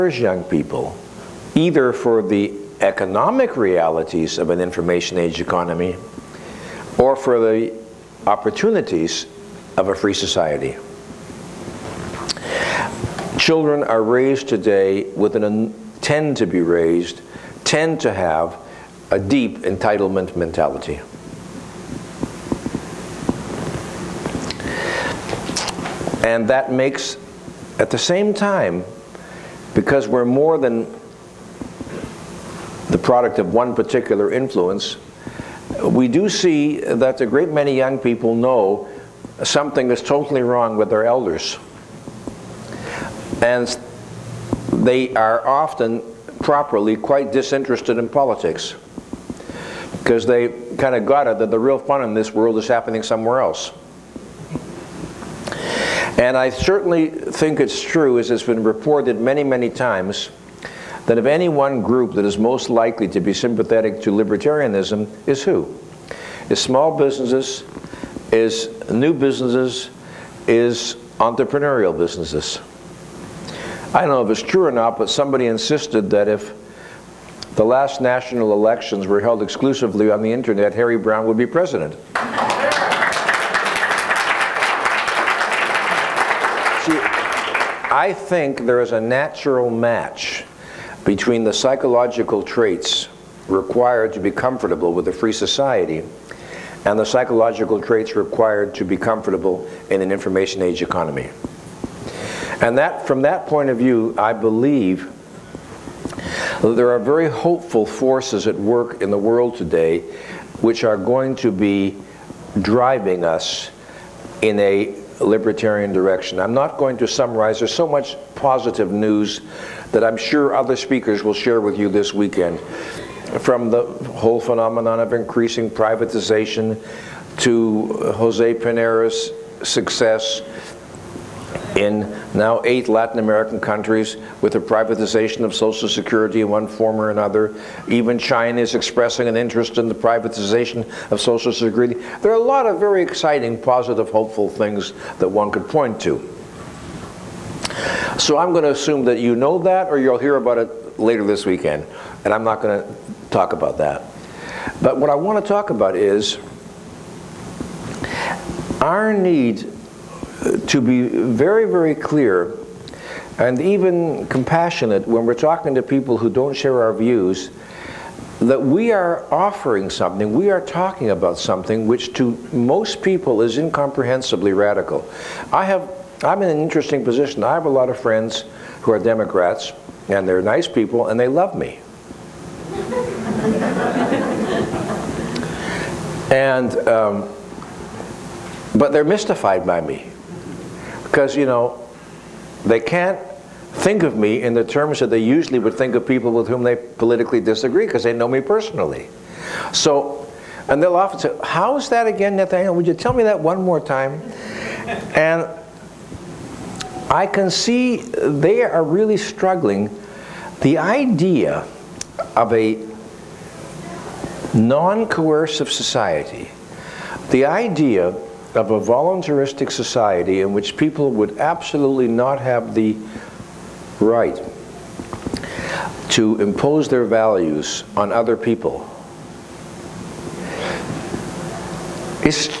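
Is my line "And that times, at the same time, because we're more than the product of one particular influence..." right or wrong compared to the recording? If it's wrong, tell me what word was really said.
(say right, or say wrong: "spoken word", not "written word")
wrong: "makes", not "times".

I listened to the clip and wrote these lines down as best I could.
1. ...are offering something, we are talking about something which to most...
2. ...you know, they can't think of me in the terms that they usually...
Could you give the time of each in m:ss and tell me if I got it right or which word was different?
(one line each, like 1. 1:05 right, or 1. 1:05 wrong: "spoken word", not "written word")
1. 2:48 right
2. 3:11 right.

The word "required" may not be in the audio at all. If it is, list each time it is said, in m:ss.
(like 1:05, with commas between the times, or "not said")
1:33, 1:38.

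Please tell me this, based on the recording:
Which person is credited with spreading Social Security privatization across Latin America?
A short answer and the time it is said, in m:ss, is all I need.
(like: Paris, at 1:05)
Jose Pinera, at 2:08.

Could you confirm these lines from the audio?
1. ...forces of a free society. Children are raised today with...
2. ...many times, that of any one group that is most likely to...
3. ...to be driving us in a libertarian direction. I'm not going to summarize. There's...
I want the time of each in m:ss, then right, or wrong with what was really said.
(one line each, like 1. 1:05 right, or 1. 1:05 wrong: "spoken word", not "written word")
1. 0:08 wrong: "opportunities", not "forces"
2. 0:59 right
3. 1:51 right.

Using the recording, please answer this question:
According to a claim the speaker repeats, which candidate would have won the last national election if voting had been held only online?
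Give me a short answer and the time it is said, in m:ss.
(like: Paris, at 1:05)
Harry Browne, at 1:20.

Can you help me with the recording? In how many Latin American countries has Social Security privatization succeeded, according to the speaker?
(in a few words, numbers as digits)
8.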